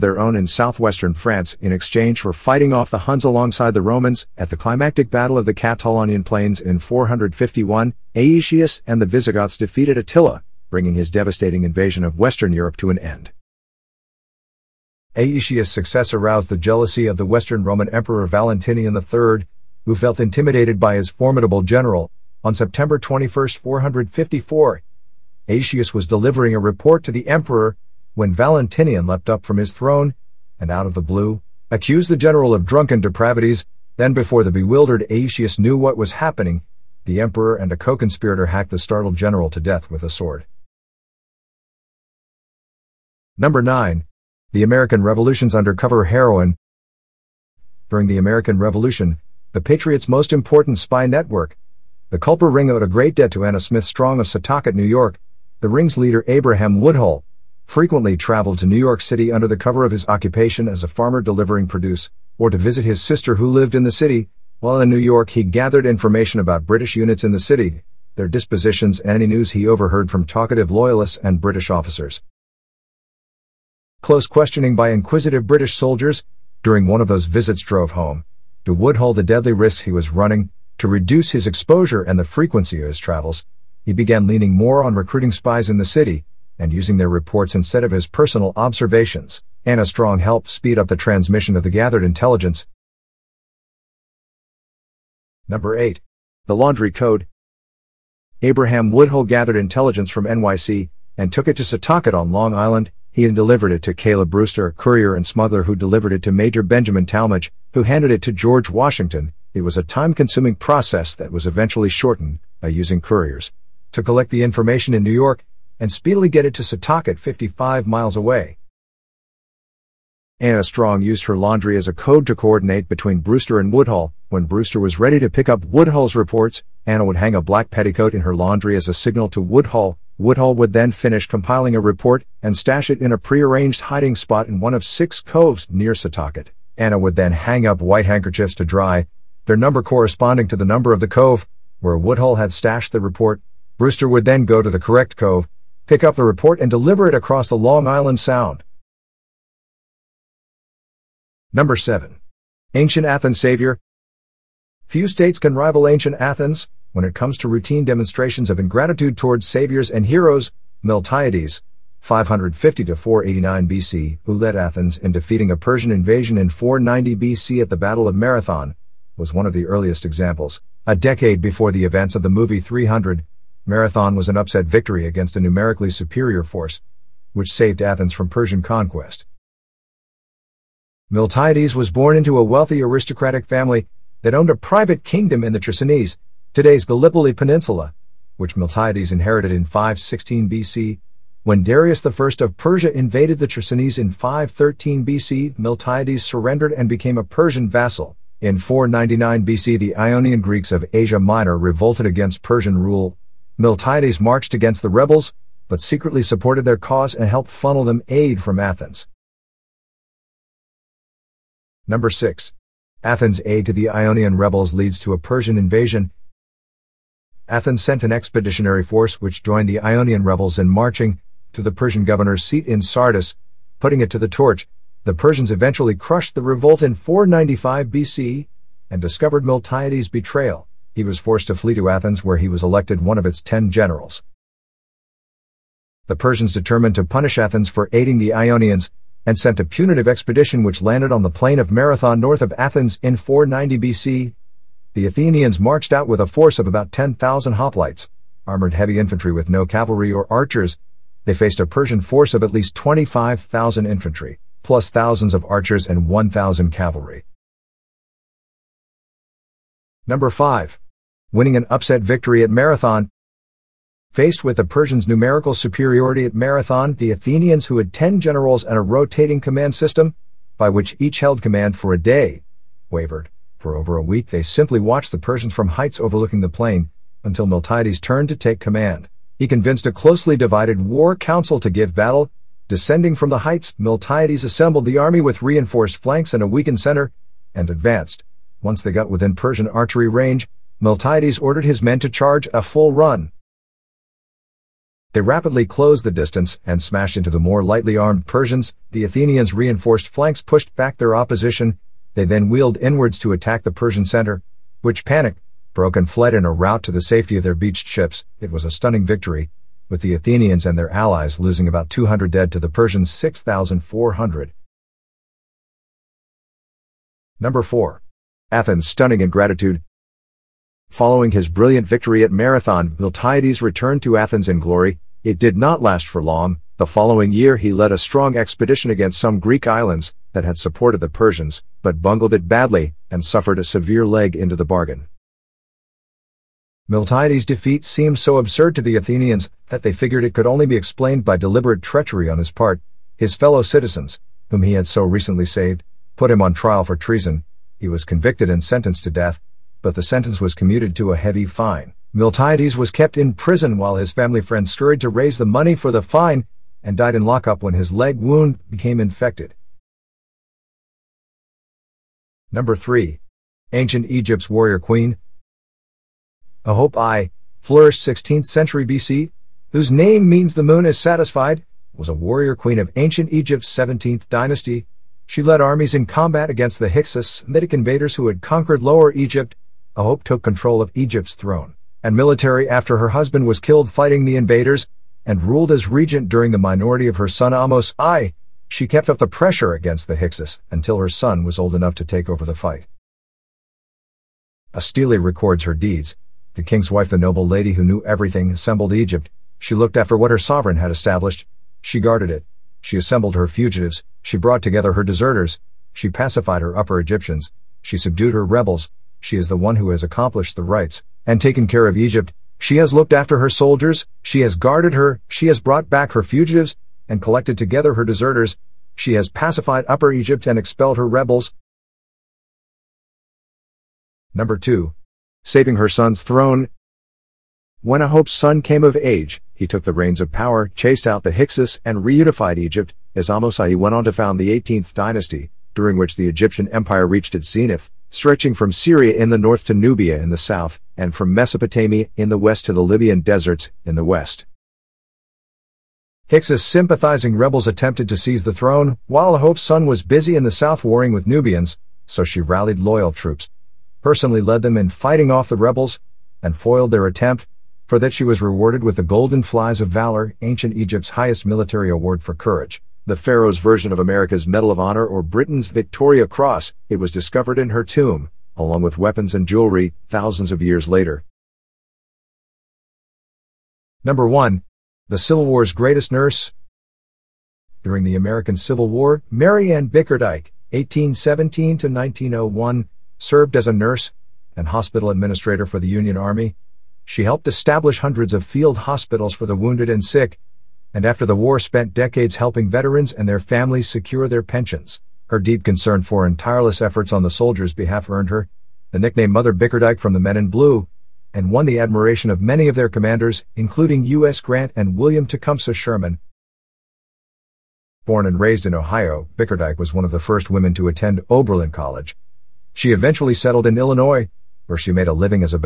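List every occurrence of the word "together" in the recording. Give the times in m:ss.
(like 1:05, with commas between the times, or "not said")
6:44, 6:57.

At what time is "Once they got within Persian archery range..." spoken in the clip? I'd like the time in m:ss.
4:48.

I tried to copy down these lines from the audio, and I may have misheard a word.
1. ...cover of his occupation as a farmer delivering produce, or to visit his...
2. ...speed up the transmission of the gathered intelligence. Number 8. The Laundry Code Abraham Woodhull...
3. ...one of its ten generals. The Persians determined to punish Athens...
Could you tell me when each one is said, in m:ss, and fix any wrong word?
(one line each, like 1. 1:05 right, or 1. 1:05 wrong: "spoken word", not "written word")
1. 0:59 right
2. 1:30 right
3. 3:53 right.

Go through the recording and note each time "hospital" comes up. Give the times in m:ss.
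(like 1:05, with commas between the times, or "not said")
8:04, 8:08.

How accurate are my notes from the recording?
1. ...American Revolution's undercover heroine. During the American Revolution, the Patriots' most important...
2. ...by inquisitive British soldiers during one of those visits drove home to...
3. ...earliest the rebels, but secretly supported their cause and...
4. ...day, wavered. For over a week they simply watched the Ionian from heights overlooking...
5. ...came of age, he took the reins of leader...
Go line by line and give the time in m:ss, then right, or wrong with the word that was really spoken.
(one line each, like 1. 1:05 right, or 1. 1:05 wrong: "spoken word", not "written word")
1. 0:44 right
2. 1:14 right
3. 3:24 wrong: "against", not "earliest"
4. 4:31 wrong: "Persians", not "Ionian"
5. 7:08 wrong: "power", not "leader".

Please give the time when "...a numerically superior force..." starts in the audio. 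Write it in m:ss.
2:55.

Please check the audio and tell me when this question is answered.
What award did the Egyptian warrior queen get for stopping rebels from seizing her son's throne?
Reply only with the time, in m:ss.
7:39.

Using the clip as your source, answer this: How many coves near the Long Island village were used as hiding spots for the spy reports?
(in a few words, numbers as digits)
6.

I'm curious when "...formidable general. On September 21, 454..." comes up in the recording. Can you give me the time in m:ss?
0:21.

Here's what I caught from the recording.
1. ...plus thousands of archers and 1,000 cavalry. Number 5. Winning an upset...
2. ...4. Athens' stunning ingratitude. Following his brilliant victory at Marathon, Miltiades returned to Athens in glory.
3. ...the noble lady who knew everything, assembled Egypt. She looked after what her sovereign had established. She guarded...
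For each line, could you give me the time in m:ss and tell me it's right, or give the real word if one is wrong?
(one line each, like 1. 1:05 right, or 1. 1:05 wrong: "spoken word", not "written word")
1. 4:14 right
2. 5:17 right
3. 6:37 right.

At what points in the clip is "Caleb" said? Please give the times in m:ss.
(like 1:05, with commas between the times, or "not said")
1:43.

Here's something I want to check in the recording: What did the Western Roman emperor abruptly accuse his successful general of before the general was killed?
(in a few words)
Drunken depravities.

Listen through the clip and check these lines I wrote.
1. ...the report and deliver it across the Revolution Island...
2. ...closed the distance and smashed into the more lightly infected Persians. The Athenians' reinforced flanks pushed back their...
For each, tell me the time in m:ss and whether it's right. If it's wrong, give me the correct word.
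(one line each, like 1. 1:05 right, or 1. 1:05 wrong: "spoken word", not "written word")
1. 2:26 wrong: "Long", not "Revolution"
2. 4:55 wrong: "armed", not "infected".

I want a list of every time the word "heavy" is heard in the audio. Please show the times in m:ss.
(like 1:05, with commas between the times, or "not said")
4:08, 5:51.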